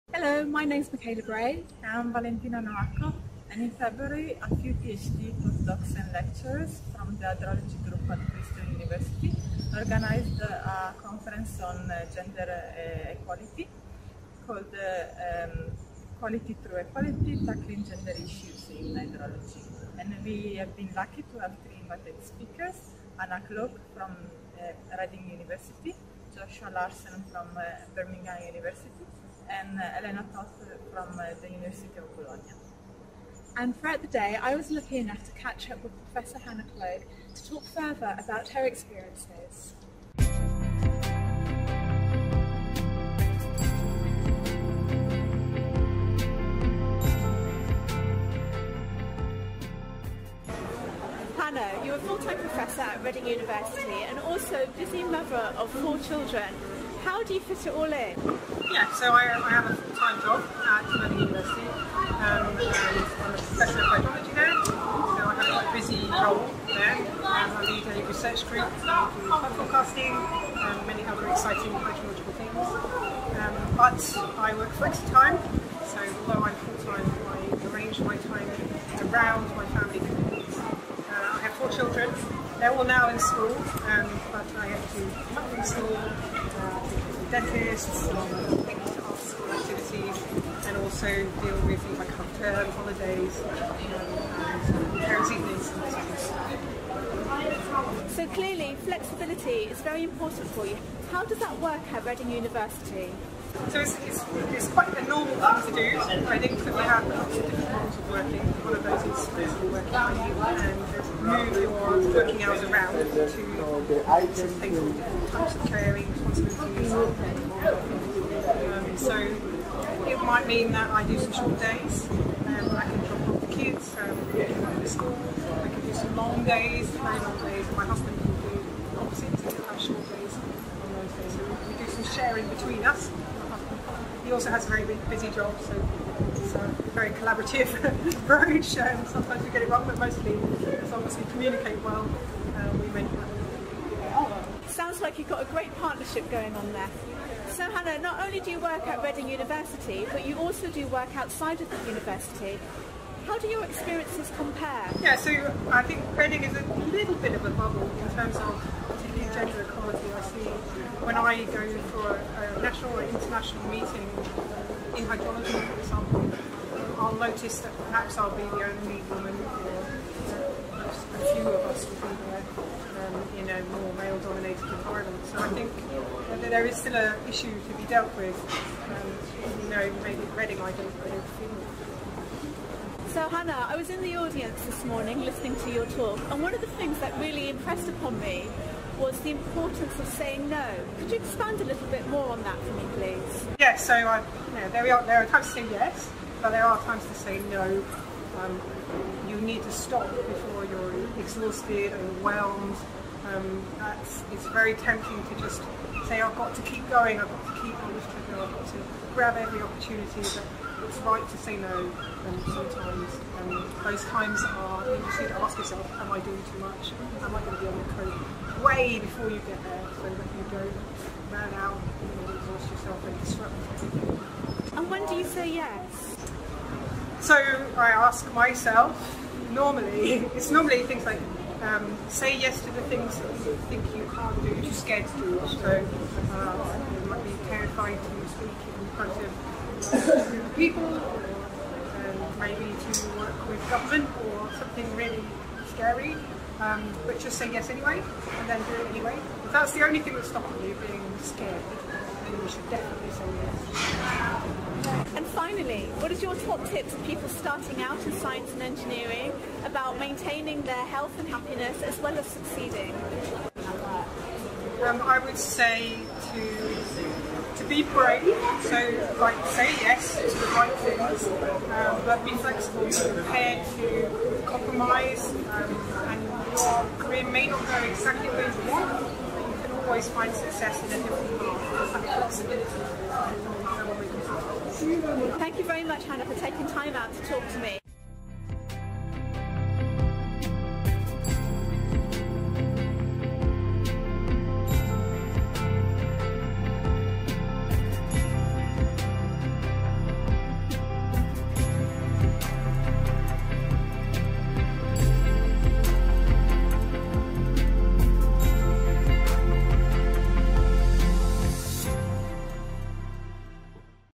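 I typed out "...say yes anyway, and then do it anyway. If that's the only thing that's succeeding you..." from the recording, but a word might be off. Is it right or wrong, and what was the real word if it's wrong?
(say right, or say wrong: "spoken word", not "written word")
wrong: "stopping", not "succeeding".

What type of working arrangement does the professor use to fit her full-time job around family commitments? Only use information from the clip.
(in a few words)
Flexi-time.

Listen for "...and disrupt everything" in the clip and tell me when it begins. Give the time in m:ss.
3:43.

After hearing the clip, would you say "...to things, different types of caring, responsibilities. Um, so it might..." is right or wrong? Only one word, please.
right.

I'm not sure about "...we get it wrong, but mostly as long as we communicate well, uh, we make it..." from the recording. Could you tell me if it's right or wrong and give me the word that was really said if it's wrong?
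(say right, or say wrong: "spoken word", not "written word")
right.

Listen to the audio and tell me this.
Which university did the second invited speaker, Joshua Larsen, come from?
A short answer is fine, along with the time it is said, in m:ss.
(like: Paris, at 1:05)
Birmingham University, at 0:27.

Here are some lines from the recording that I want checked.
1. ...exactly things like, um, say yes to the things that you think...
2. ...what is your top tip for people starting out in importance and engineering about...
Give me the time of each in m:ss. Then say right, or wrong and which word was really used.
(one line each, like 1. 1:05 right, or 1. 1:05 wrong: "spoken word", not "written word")
1. 3:50 wrong: "normally", not "exactly"
2. 4:15 wrong: "science", not "importance".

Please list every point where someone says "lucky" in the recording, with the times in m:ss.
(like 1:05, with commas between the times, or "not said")
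0:20, 0:34.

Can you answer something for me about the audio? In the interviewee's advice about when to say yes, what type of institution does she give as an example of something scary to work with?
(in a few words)
Government.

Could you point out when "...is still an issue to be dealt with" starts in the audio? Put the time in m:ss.
2:56.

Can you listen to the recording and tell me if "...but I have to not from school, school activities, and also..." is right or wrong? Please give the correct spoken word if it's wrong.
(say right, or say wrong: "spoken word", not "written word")
right.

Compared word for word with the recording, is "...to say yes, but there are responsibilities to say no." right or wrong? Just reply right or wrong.
wrong.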